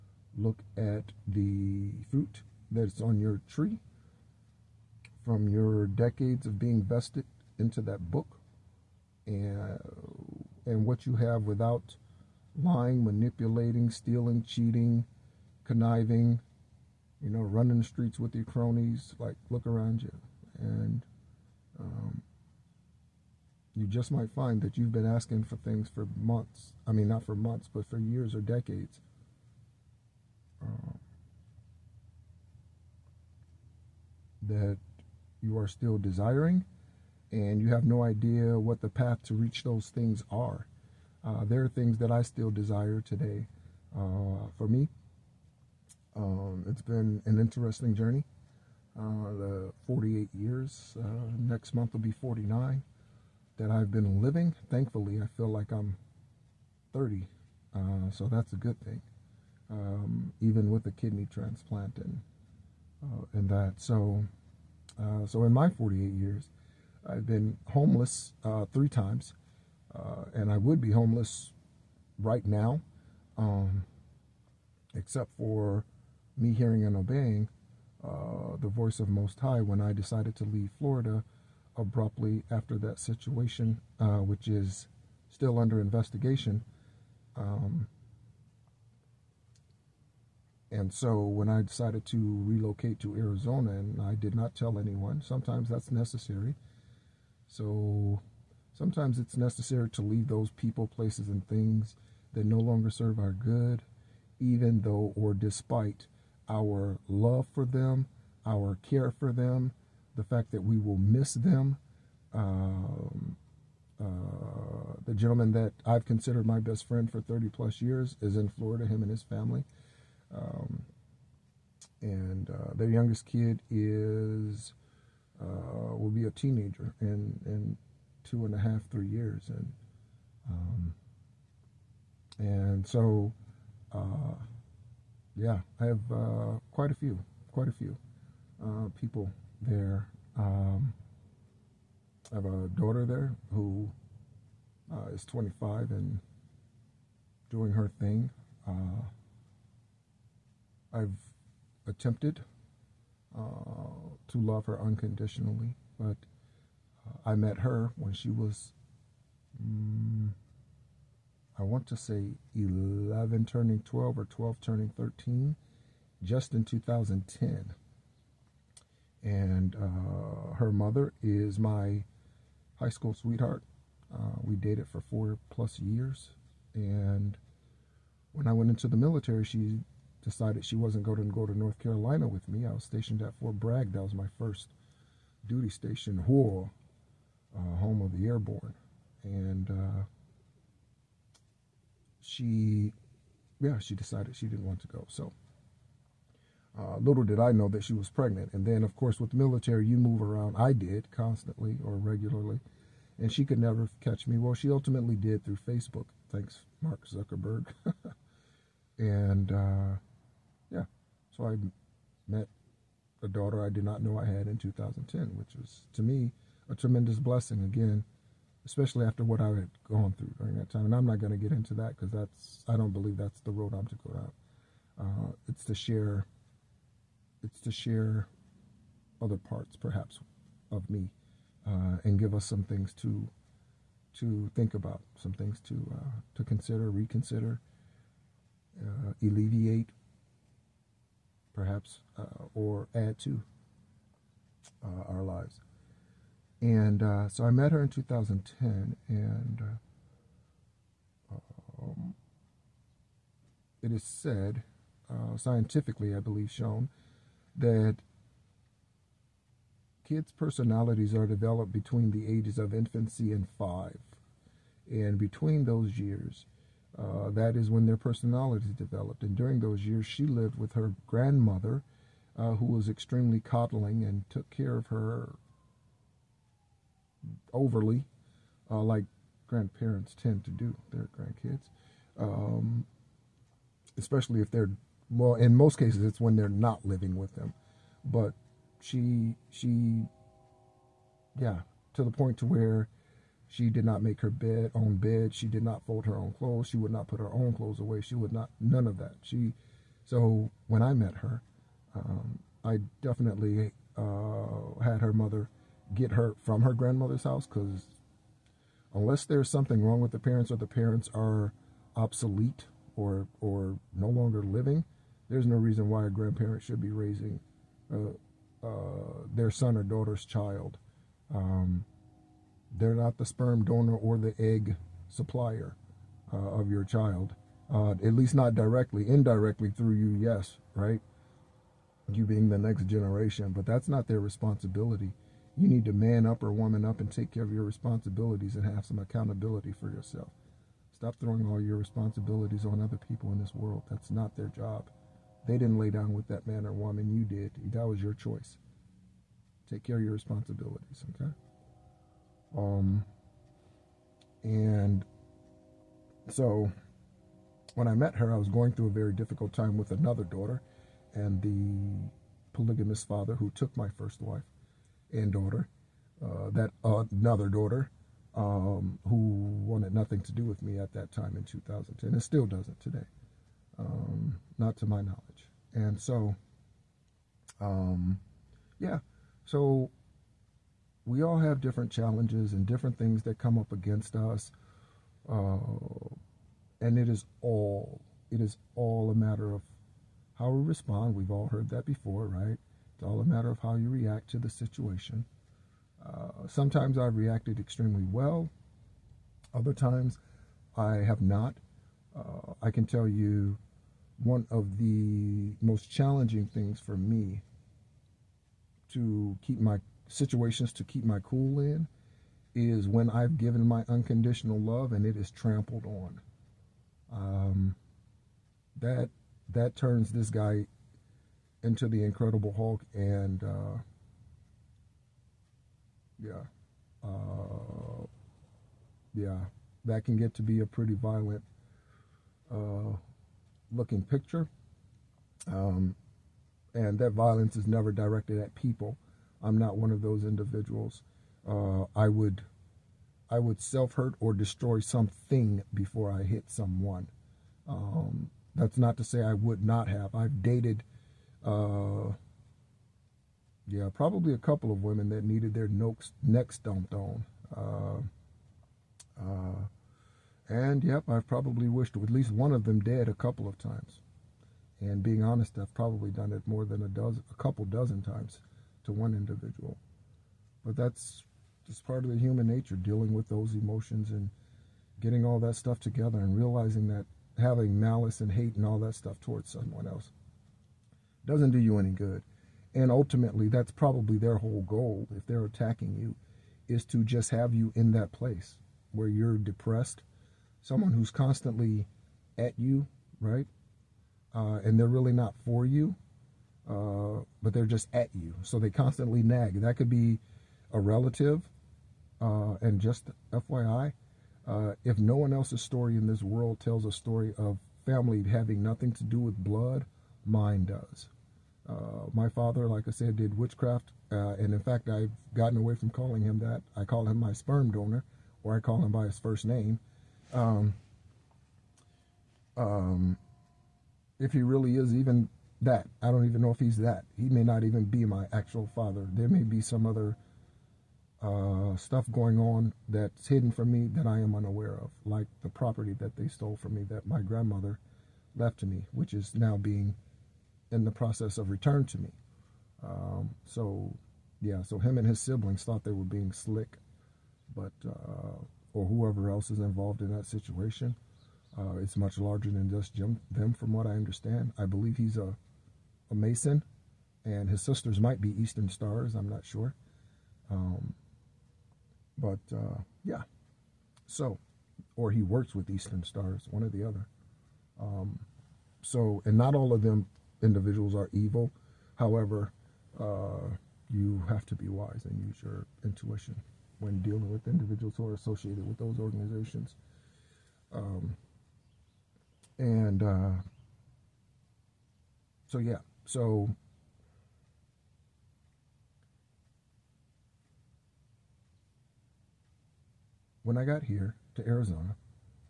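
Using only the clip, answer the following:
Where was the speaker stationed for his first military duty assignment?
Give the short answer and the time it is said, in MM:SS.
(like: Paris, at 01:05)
Fort Bragg, at 03:03.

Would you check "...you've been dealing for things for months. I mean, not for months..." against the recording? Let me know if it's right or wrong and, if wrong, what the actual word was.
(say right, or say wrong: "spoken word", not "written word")
wrong: "asking", not "dealing".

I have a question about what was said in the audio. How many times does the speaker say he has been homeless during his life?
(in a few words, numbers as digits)
3.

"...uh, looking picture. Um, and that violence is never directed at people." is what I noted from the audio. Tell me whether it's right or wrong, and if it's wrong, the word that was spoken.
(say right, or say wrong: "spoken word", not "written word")
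right.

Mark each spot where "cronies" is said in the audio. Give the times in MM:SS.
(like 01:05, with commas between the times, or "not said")
00:18.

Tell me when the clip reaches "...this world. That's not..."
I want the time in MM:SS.
05:43.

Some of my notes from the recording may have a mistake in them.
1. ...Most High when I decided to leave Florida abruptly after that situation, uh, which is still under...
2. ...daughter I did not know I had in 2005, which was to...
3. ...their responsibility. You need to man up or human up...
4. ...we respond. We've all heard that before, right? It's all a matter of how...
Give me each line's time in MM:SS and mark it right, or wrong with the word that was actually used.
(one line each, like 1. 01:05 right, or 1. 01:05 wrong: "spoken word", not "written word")
1. 01:19 right
2. 03:33 wrong: "2010", not "2005"
3. 05:34 wrong: "woman", not "human"
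4. 06:30 right.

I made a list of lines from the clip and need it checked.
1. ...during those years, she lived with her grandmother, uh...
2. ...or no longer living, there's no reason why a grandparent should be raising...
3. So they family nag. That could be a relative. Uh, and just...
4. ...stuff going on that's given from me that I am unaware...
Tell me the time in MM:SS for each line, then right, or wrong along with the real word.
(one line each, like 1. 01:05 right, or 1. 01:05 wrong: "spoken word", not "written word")
1. 04:29 right
2. 05:13 right
3. 08:18 wrong: "constantly", not "family"
4. 08:51 wrong: "hidden", not "given".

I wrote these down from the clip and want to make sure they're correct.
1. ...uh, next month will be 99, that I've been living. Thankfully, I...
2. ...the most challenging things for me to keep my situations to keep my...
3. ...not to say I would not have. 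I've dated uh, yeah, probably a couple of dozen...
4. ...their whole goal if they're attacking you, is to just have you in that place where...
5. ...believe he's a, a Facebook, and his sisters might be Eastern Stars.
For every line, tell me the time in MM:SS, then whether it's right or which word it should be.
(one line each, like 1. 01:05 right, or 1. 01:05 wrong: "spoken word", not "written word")
1. 00:51 wrong: "49", not "99"
2. 06:44 right
3. 07:28 wrong: "women", not "dozen"
4. 08:04 right
5. 09:14 wrong: "Mason", not "Facebook".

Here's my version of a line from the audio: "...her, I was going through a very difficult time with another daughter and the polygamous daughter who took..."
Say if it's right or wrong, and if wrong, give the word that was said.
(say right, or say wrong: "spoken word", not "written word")
wrong: "father", not "daughter".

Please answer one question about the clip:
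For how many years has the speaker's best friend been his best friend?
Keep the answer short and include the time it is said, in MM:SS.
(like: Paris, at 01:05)
30 plus, at 01:57.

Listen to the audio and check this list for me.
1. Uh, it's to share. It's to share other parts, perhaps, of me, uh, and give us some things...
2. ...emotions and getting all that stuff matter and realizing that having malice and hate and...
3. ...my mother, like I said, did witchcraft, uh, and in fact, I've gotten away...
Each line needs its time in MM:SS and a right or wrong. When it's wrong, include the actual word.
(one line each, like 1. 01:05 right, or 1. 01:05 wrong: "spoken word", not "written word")
1. 03:44 right
2. 07:53 wrong: "together", not "matter"
3. 08:32 wrong: "father", not "mother".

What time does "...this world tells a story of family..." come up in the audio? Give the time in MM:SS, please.
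08:26.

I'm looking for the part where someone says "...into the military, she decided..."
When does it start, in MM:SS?
02:58.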